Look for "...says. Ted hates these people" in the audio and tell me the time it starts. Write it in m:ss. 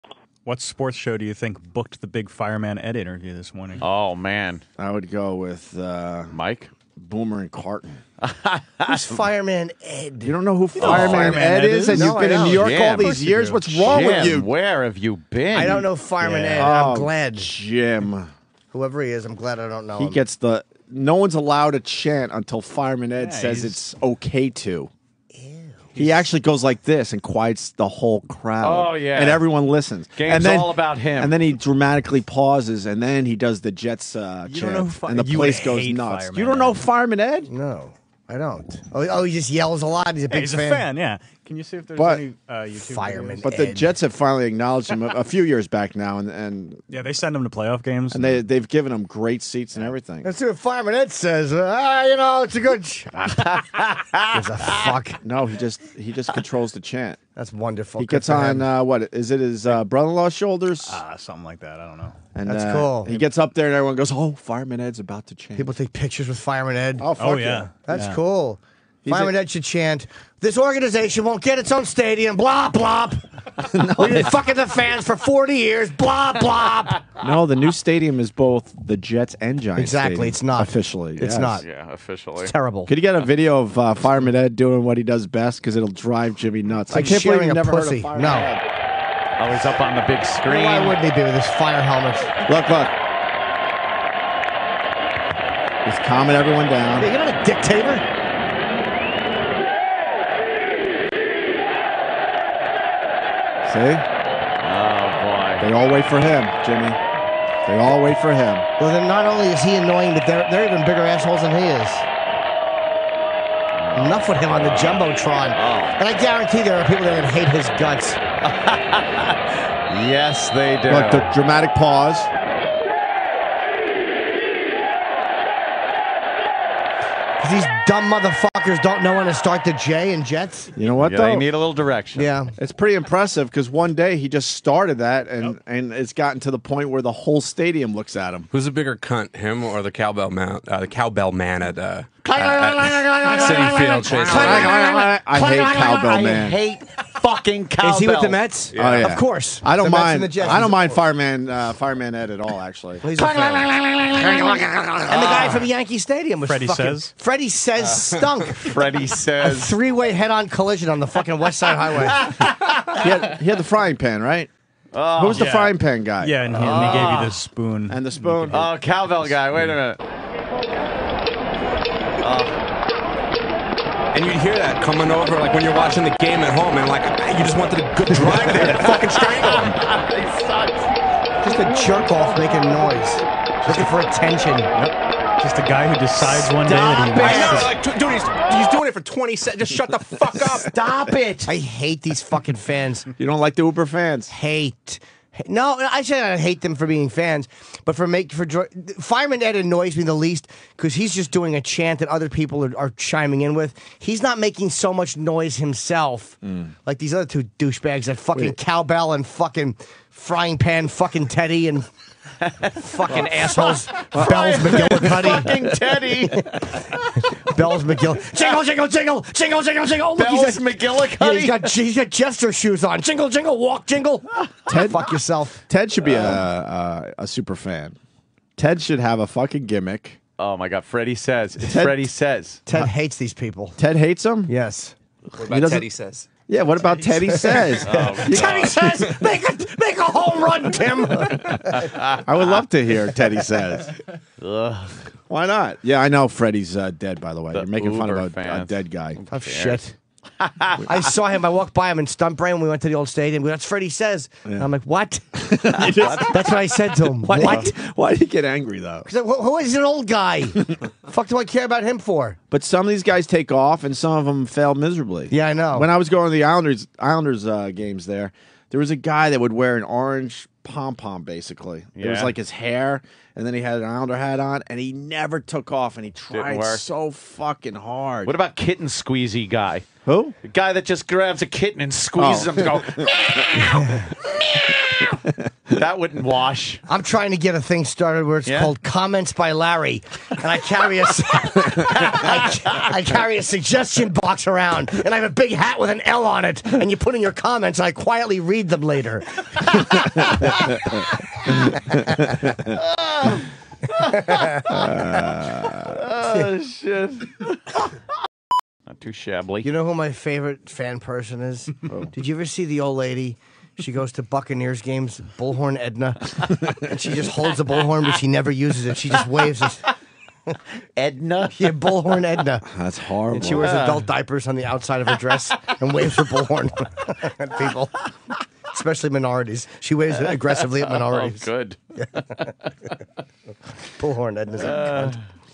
3:52.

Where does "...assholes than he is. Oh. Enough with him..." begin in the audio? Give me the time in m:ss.
1:51.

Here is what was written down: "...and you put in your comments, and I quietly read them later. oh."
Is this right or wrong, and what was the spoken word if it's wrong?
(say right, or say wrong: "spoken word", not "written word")
right.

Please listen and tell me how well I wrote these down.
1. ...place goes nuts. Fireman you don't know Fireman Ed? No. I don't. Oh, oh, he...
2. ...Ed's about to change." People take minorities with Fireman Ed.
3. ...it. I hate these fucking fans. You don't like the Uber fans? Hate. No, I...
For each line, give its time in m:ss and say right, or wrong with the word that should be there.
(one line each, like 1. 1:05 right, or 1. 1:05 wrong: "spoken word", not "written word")
1. 0:35 right
2. 1:04 wrong: "pictures", not "minorities"
3. 3:11 right.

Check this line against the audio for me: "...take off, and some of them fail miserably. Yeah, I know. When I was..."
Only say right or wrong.
right.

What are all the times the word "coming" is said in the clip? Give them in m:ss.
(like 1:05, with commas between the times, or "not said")
2:54.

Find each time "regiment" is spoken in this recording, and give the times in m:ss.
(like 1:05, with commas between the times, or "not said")
not said.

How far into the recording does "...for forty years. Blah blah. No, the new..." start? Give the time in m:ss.
1:15.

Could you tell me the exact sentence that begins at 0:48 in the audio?
and they they've given him great seats and everything.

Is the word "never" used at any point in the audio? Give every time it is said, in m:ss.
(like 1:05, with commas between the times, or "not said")
1:27, 4:34, 5:18.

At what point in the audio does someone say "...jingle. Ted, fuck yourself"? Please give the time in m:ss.
3:43.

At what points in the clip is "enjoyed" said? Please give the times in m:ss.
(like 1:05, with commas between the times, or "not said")
not said.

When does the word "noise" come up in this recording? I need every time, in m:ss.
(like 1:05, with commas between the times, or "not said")
3:02, 3:25.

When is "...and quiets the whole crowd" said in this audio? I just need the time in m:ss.
0:27.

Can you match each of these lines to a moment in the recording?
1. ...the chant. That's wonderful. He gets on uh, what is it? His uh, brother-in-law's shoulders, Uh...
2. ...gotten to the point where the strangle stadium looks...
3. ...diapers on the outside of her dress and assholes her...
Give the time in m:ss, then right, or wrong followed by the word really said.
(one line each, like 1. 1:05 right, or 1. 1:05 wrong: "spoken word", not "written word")
1. 0:56 right
2. 2:16 wrong: "whole", not "strangle"
3. 5:24 wrong: "waves", not "assholes".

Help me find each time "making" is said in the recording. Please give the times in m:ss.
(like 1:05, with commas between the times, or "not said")
3:02, 3:24, 4:07.